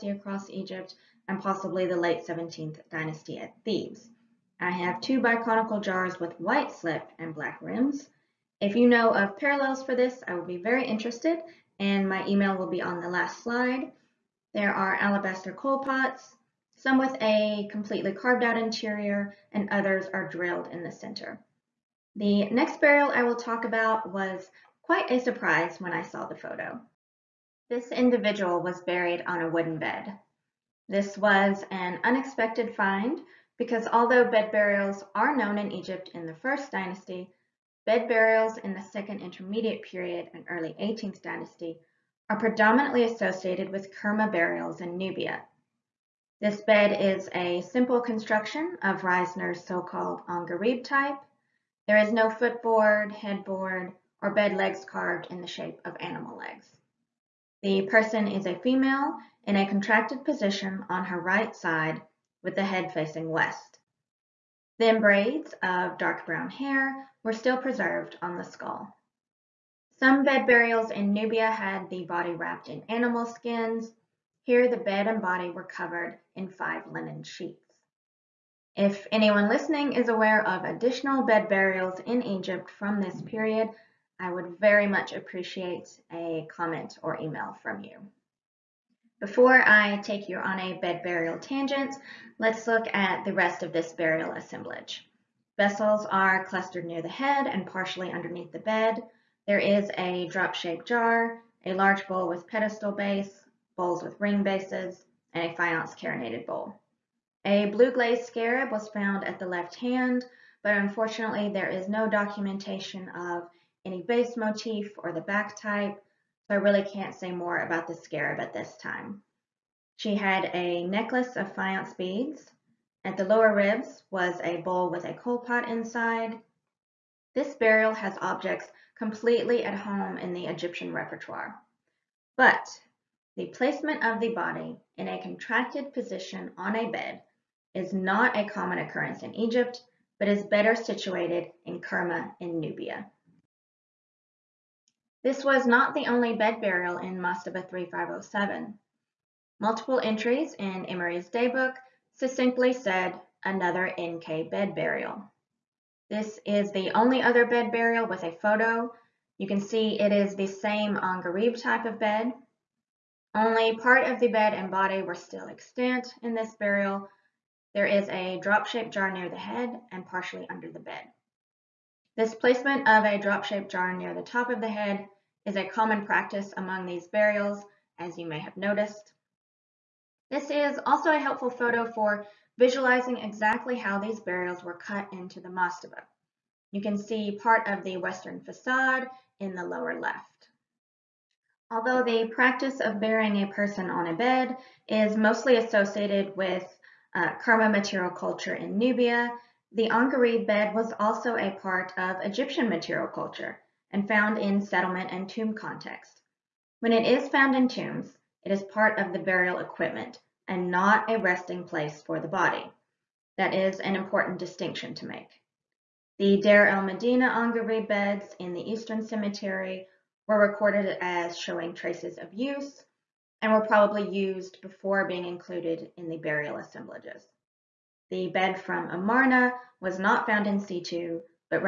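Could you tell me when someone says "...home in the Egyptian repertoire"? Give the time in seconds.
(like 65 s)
129 s.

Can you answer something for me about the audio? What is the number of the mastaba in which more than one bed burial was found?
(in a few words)
3507.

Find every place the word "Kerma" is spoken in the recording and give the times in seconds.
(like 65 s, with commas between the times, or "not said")
43 s, 141 s, 197 s.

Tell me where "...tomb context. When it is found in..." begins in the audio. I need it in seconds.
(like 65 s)
205 s.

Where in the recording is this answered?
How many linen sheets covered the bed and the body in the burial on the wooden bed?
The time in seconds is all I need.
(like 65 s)
76 s.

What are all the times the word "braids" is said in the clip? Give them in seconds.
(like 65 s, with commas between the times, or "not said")
64 s.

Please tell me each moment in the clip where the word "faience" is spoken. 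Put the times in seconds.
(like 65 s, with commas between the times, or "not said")
105 s, 121 s.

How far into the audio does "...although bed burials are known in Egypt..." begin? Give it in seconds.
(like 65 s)
33 s.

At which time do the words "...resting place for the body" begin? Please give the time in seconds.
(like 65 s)
211 s.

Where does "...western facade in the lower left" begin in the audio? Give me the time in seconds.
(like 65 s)
187 s.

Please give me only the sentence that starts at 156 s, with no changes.
This is the only other bed burial with a photo.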